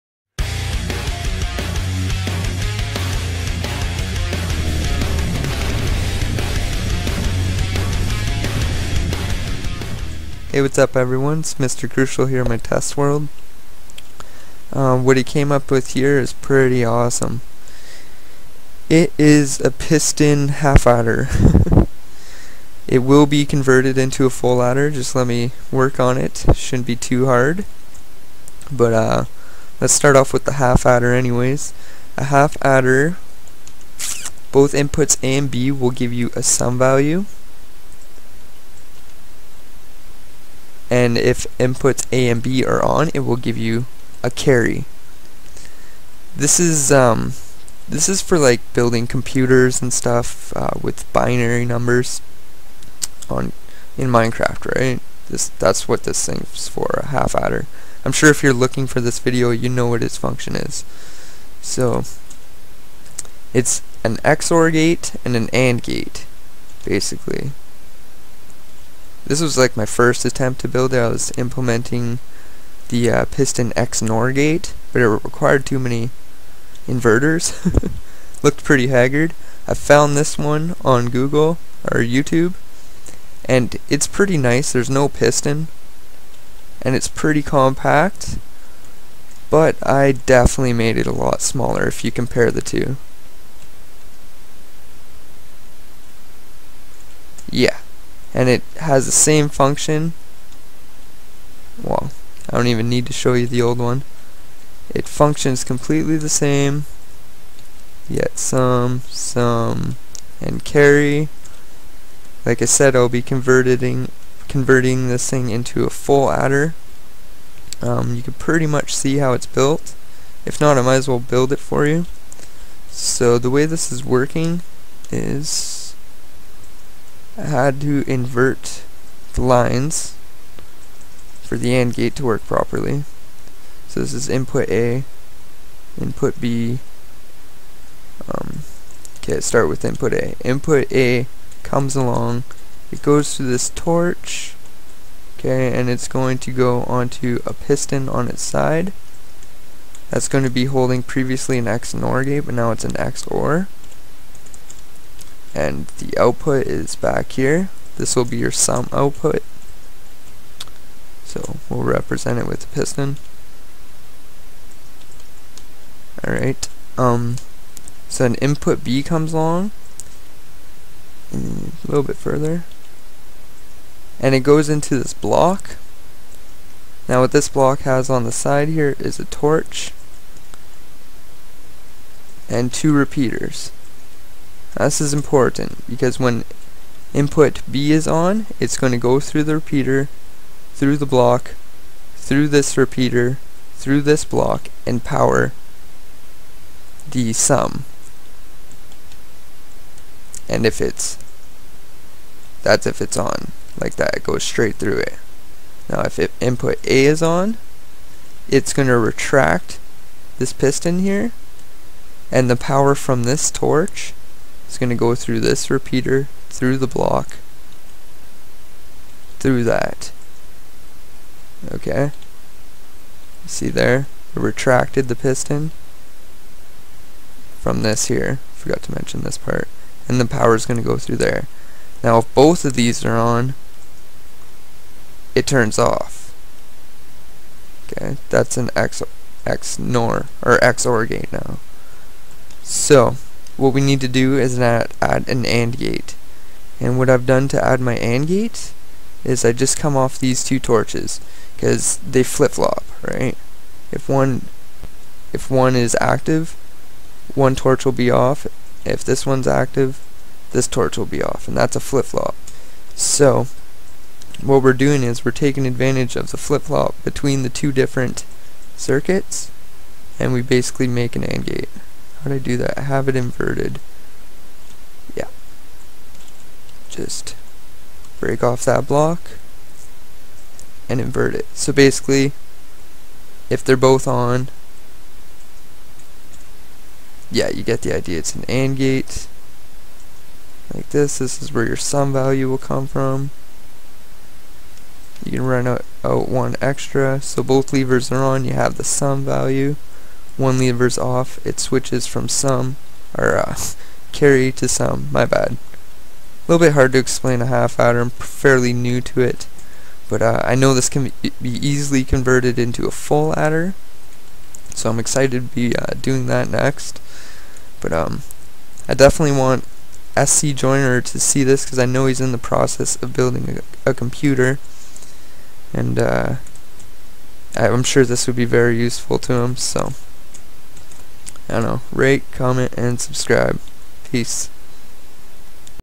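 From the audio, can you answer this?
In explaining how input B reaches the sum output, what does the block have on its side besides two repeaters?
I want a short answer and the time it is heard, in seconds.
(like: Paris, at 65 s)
A torch, at 179 s.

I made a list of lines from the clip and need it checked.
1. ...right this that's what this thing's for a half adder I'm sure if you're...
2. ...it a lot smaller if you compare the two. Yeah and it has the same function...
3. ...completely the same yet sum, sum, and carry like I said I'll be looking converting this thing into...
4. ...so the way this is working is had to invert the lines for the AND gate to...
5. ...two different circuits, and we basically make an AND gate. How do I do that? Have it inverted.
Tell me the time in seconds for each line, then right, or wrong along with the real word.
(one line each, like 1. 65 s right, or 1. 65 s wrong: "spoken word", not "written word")
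1. 54 s right
2. 90 s right
3. 105 s wrong: "converting", not "looking"
4. 122 s right
5. 267 s right.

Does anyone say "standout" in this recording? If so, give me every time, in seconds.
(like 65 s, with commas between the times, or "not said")
not said.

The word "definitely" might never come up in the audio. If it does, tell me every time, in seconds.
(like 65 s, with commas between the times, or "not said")
90 s, 318 s.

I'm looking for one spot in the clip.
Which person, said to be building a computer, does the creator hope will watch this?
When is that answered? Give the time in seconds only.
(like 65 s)
320 s.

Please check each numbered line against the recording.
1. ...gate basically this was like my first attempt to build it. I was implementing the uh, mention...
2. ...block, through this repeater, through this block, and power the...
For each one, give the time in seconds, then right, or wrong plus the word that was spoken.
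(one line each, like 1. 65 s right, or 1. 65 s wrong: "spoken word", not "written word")
1. 65 s wrong: "piston", not "mention"
2. 191 s right.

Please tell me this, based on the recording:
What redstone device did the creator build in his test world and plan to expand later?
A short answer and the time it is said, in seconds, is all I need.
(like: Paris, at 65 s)
Piston half adder, at 19 s.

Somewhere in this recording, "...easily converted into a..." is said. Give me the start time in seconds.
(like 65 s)
311 s.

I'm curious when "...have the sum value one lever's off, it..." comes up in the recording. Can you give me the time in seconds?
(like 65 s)
298 s.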